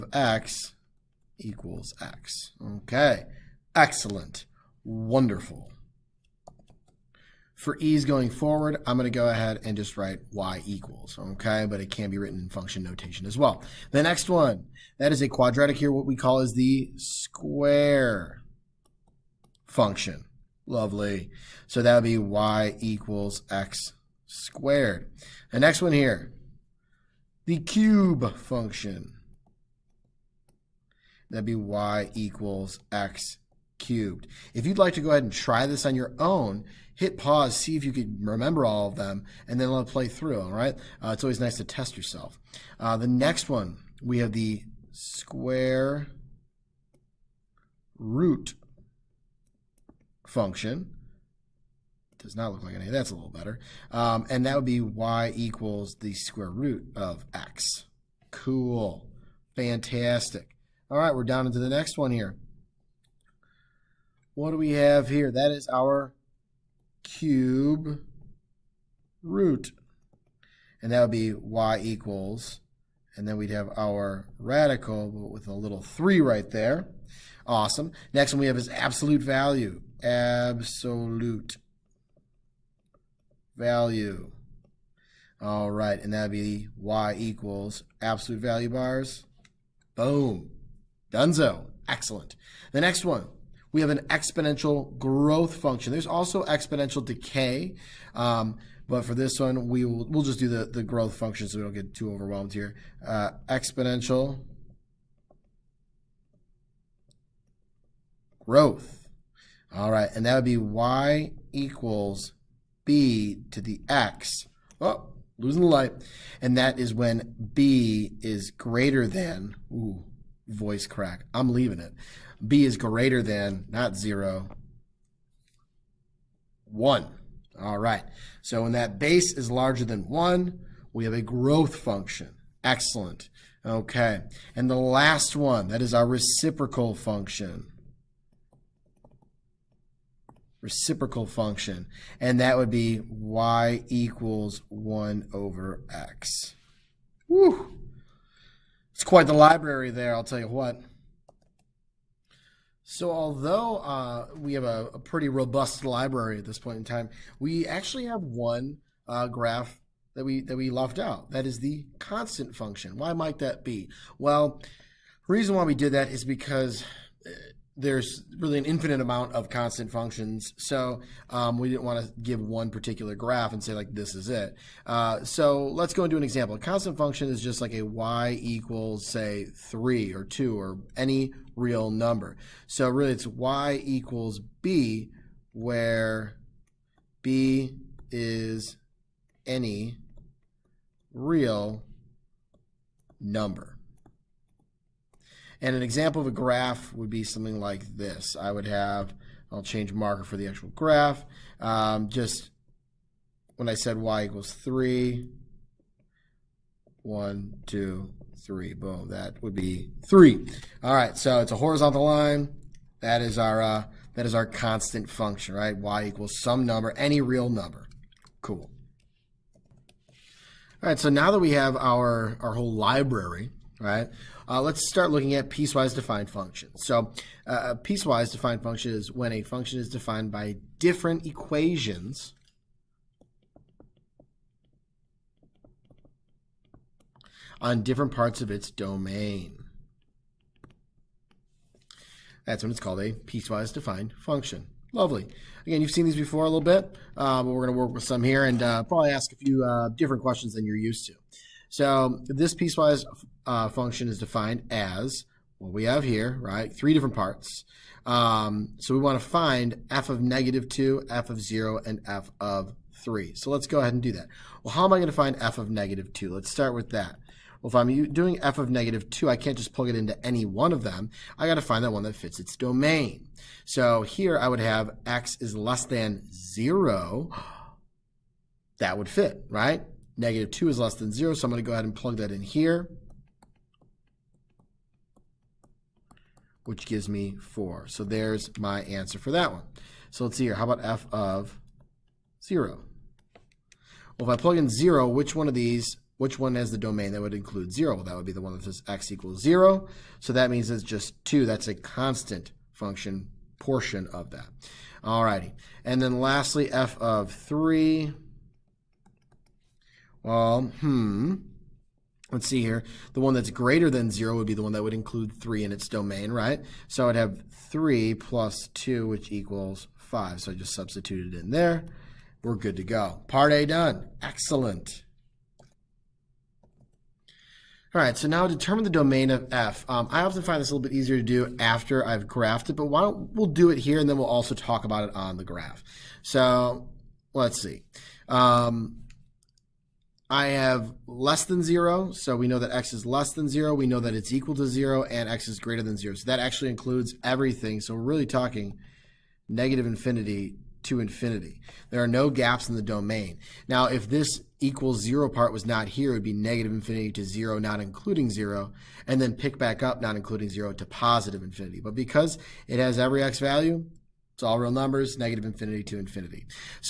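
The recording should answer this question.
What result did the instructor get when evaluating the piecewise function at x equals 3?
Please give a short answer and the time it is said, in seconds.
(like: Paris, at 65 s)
5, at 319 s.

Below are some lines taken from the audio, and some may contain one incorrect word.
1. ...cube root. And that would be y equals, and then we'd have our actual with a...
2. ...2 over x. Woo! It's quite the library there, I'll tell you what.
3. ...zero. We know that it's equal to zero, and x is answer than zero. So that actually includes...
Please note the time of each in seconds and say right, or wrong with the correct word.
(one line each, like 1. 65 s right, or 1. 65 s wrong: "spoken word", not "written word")
1. 67 s wrong: "radical", not "actual"
2. 144 s wrong: "1", not "2"
3. 343 s wrong: "greater", not "answer".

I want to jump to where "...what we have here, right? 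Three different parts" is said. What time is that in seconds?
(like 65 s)
255 s.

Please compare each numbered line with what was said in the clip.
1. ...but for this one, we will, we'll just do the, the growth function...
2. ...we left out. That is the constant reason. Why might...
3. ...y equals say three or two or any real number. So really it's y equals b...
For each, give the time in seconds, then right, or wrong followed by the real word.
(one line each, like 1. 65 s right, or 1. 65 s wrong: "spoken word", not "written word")
1. 98 s right
2. 160 s wrong: "function", not "reason"
3. 177 s right.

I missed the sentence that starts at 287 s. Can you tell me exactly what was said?
So there's my answer for that one.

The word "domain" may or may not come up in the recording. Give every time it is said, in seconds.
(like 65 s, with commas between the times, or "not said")
238 s, 272 s, 296 s, 315 s, 328 s, 352 s.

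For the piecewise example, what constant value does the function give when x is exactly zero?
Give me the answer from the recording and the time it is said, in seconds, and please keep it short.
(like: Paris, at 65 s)
2, at 300 s.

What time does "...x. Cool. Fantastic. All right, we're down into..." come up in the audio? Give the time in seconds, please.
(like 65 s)
57 s.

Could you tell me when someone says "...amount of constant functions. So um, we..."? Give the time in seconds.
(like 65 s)
168 s.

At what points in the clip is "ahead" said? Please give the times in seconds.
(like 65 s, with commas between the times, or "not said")
9 s, 35 s, 263 s, 281 s.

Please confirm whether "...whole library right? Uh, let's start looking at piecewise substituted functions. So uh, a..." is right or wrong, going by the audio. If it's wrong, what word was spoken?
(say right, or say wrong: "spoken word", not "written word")
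wrong: "defined", not "substituted".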